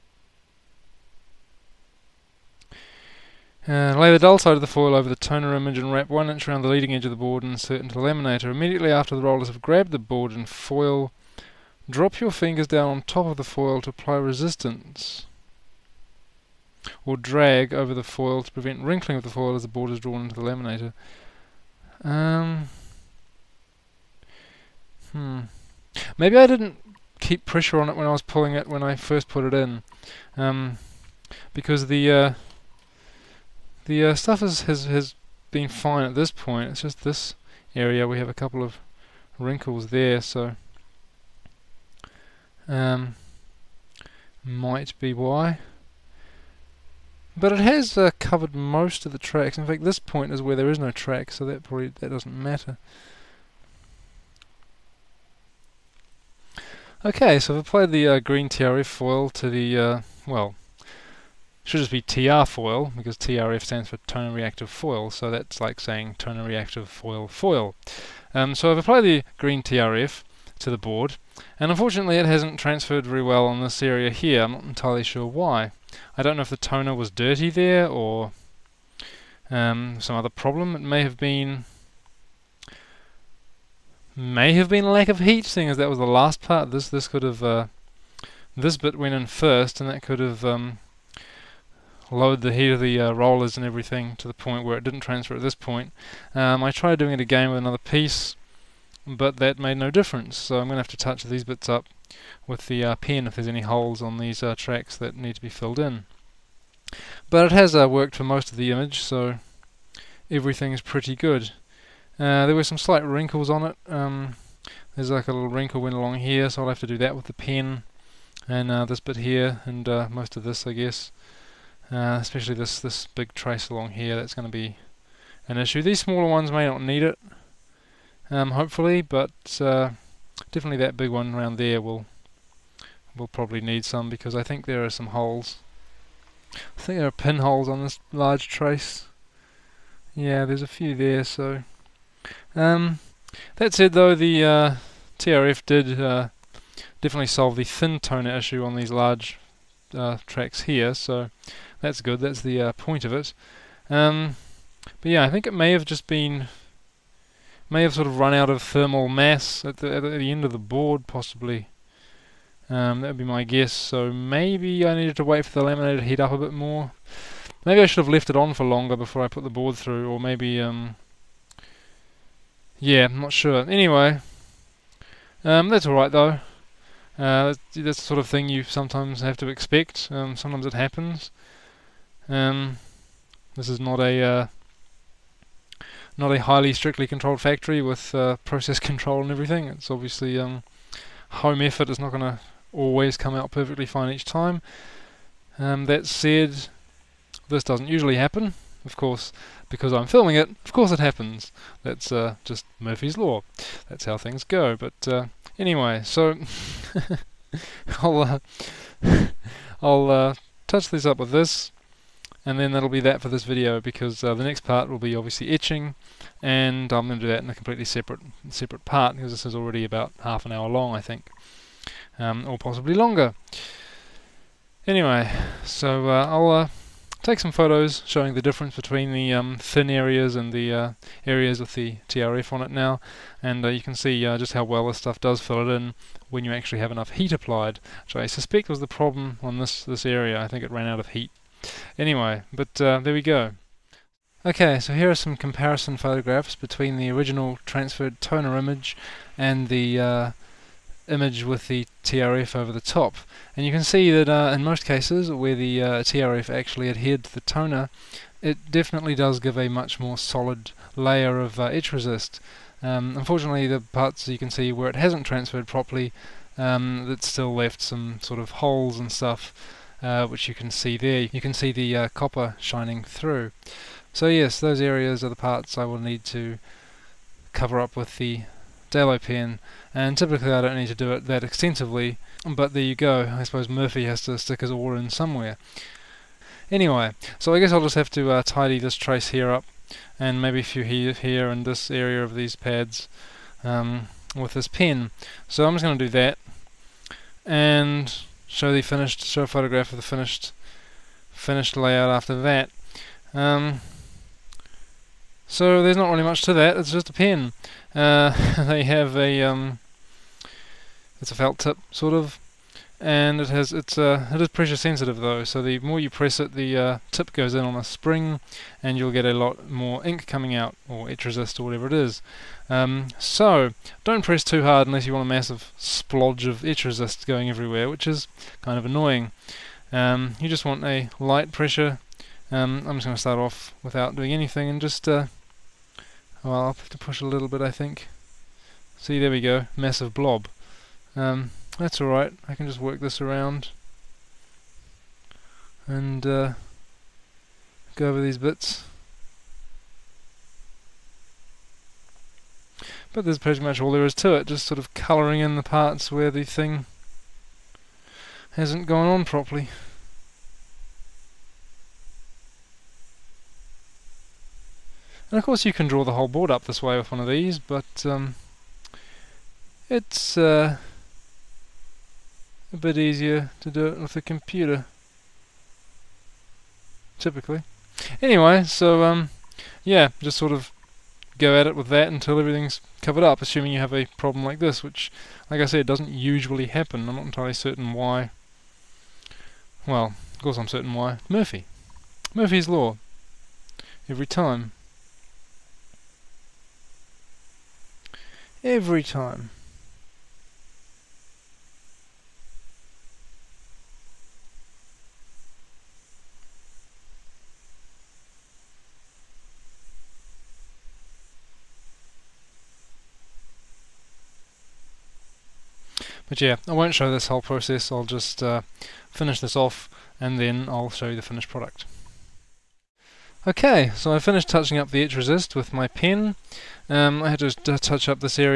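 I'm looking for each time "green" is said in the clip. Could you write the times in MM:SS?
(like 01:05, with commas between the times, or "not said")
00:58, 01:09.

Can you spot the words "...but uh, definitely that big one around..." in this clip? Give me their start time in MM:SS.
02:09.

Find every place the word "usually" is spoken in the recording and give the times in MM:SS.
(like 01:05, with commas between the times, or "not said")
03:17, 06:26.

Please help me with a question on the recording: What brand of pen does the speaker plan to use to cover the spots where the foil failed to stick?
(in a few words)
Dalo.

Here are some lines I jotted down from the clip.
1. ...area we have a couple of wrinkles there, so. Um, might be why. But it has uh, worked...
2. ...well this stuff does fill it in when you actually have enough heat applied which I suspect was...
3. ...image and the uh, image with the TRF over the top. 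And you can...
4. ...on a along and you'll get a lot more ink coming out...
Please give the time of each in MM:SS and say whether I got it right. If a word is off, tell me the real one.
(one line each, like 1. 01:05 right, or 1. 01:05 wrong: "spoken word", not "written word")
1. 00:37 wrong: "covered", not "worked"
2. 03:54 right
3. 04:08 right
4. 05:17 wrong: "spring", not "along".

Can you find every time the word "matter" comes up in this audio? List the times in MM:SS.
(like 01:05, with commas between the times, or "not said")
00:52.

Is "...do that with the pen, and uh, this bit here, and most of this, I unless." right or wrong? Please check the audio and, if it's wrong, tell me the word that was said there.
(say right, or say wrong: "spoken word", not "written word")
wrong: "guess", not "unless".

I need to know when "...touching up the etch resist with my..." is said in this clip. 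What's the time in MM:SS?
07:04.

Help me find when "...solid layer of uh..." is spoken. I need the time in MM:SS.
04:20.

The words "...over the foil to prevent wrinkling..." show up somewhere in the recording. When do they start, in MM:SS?
00:17.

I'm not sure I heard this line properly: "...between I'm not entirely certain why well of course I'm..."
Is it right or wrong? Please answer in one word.
wrong.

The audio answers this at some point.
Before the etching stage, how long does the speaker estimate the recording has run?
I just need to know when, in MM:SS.
03:40.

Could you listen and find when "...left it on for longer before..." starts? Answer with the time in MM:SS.
02:48.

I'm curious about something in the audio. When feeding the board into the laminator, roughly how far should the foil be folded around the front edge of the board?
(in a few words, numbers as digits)
1 inch.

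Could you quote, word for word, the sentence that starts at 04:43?
I suppose Murphy has to stick his oar in somewhere.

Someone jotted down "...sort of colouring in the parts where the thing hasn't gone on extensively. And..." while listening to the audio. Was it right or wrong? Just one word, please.
wrong.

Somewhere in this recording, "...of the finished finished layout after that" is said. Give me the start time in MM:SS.
04:59.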